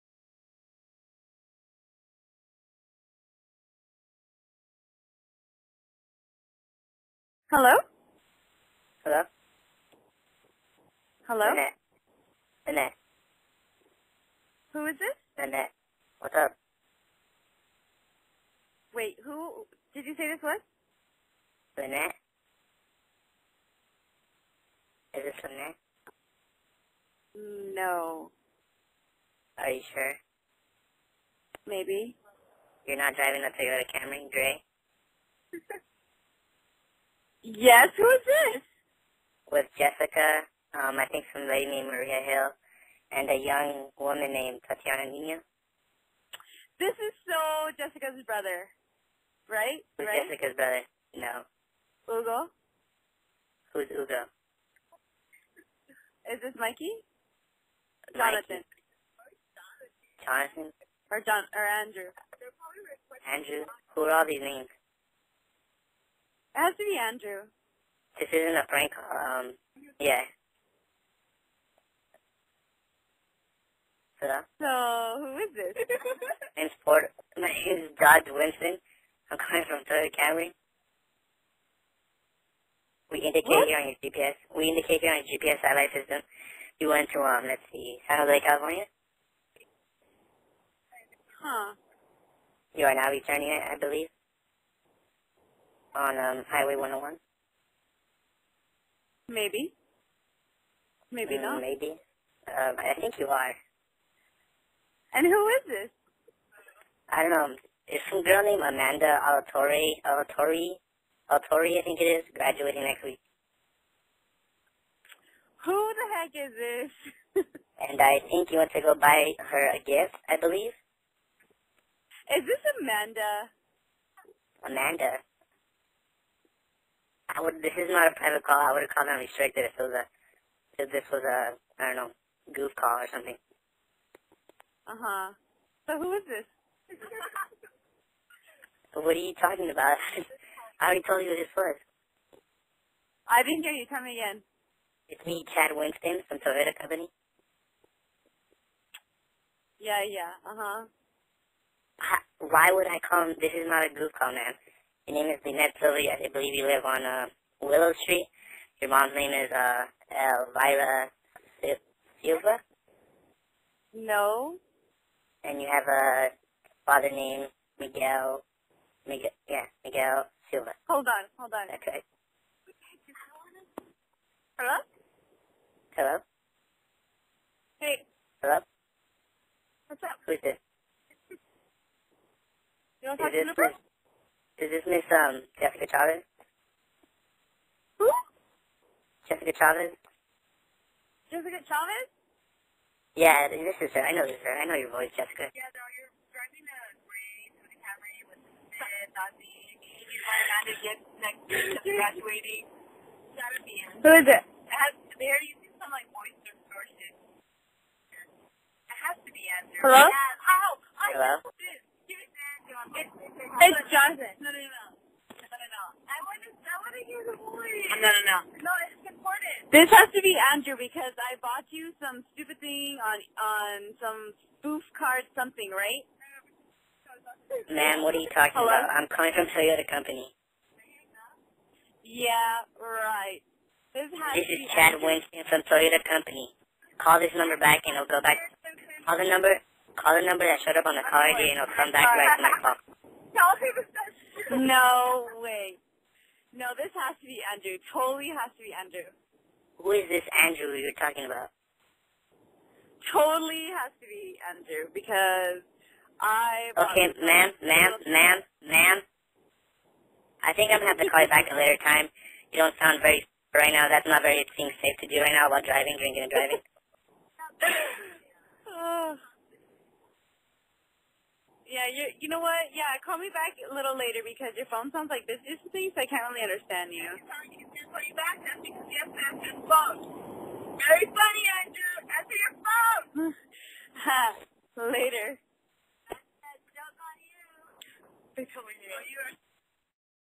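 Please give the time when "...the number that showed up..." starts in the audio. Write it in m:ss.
4:00.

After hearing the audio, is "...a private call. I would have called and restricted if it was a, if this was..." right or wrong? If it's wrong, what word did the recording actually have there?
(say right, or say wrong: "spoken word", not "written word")
right.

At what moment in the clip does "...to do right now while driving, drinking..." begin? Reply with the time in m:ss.
4:25.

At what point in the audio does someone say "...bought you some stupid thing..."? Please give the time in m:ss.
3:41.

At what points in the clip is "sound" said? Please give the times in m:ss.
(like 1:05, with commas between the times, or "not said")
4:22, 4:34.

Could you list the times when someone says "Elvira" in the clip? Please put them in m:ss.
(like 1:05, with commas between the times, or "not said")
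2:40.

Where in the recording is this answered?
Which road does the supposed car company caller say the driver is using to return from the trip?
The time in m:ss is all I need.
1:36.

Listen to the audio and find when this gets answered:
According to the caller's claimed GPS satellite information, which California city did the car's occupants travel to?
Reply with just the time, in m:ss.
1:28.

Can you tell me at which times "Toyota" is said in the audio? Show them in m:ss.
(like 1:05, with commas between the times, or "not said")
0:33, 1:19, 2:26, 3:49, 3:55.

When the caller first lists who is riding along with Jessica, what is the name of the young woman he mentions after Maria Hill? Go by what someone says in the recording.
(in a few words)
Tatiana Nino.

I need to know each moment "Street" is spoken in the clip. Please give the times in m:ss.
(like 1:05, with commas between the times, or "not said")
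2:38.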